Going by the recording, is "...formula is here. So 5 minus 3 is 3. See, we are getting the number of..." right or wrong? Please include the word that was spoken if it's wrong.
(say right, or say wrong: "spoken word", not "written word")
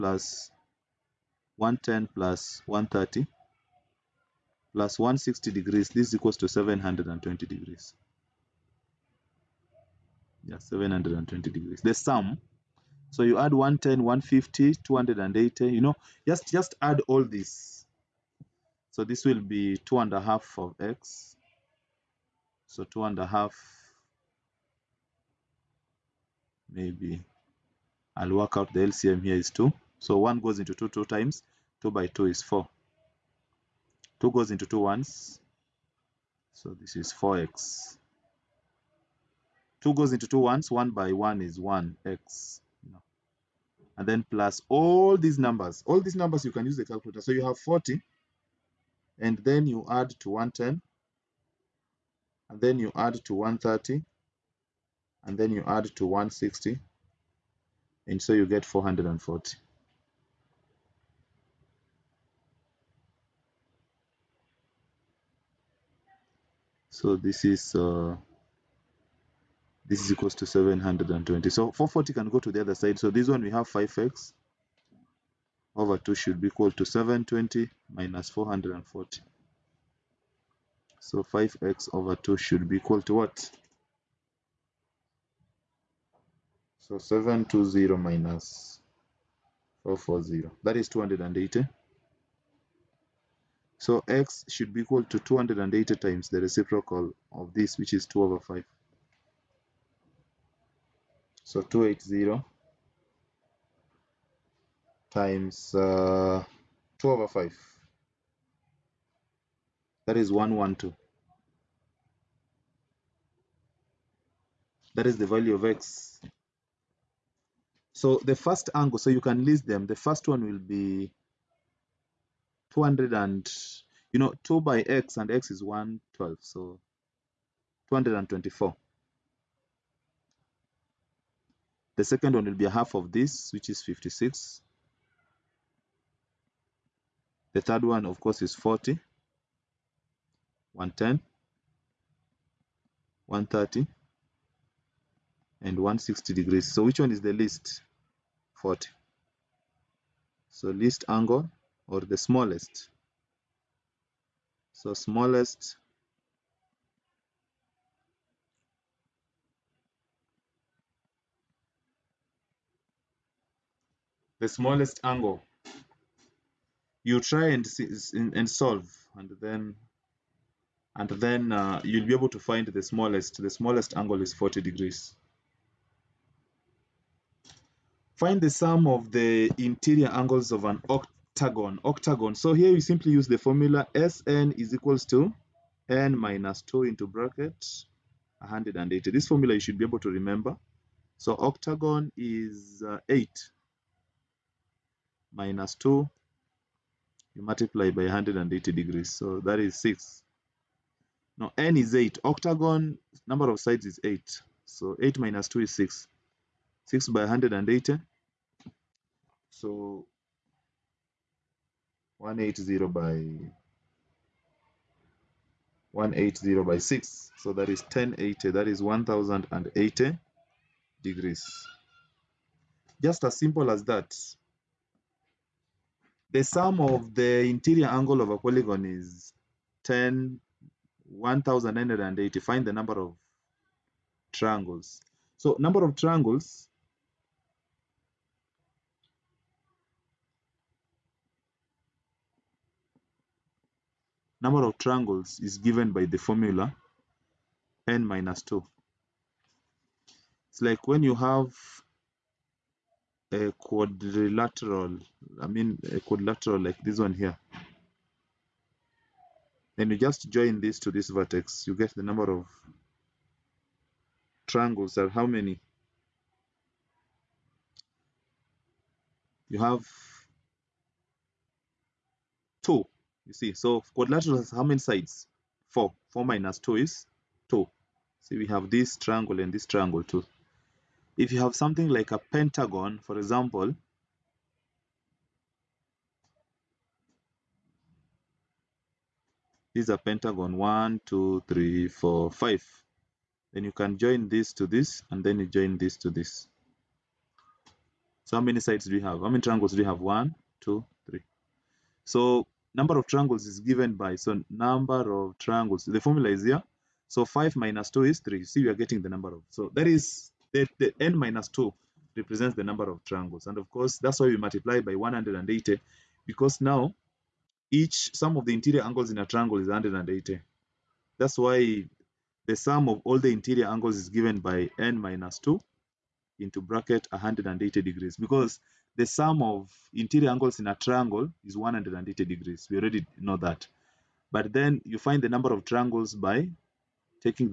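wrong: "2", not "3".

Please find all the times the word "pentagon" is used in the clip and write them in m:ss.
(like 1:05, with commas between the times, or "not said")
4:42, 4:49.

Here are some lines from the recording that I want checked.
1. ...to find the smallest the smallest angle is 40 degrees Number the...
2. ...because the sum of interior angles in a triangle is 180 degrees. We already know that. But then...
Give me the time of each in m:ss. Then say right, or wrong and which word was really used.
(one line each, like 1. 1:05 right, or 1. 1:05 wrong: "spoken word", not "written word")
1. 2:52 wrong: "Find", not "Number"
2. 5:28 right.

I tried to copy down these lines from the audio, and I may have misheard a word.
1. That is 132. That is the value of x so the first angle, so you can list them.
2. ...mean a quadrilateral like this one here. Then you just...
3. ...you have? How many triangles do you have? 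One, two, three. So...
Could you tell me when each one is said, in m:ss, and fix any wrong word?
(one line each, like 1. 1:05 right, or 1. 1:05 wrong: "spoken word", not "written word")
1. 1:50 wrong: "112", not "132"
2. 4:15 right
3. 4:58 right.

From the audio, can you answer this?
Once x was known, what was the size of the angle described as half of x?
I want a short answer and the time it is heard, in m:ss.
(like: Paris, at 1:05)
56, at 2:13.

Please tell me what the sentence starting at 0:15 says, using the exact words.
You know, just just add all this.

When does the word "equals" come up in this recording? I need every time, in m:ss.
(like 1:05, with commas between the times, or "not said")
0:06, 1:10, 1:16, 1:22, 1:34, 3:04.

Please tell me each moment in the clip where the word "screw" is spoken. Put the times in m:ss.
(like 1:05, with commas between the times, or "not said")
not said.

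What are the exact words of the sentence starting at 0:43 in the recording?
And then plus all these numbers.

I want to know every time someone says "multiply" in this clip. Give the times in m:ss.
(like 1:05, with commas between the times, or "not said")
3:17, 5:14.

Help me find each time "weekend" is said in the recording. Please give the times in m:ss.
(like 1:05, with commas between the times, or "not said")
not said.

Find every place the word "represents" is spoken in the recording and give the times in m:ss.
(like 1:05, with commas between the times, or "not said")
5:12.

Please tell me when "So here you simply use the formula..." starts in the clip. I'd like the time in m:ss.
3:02.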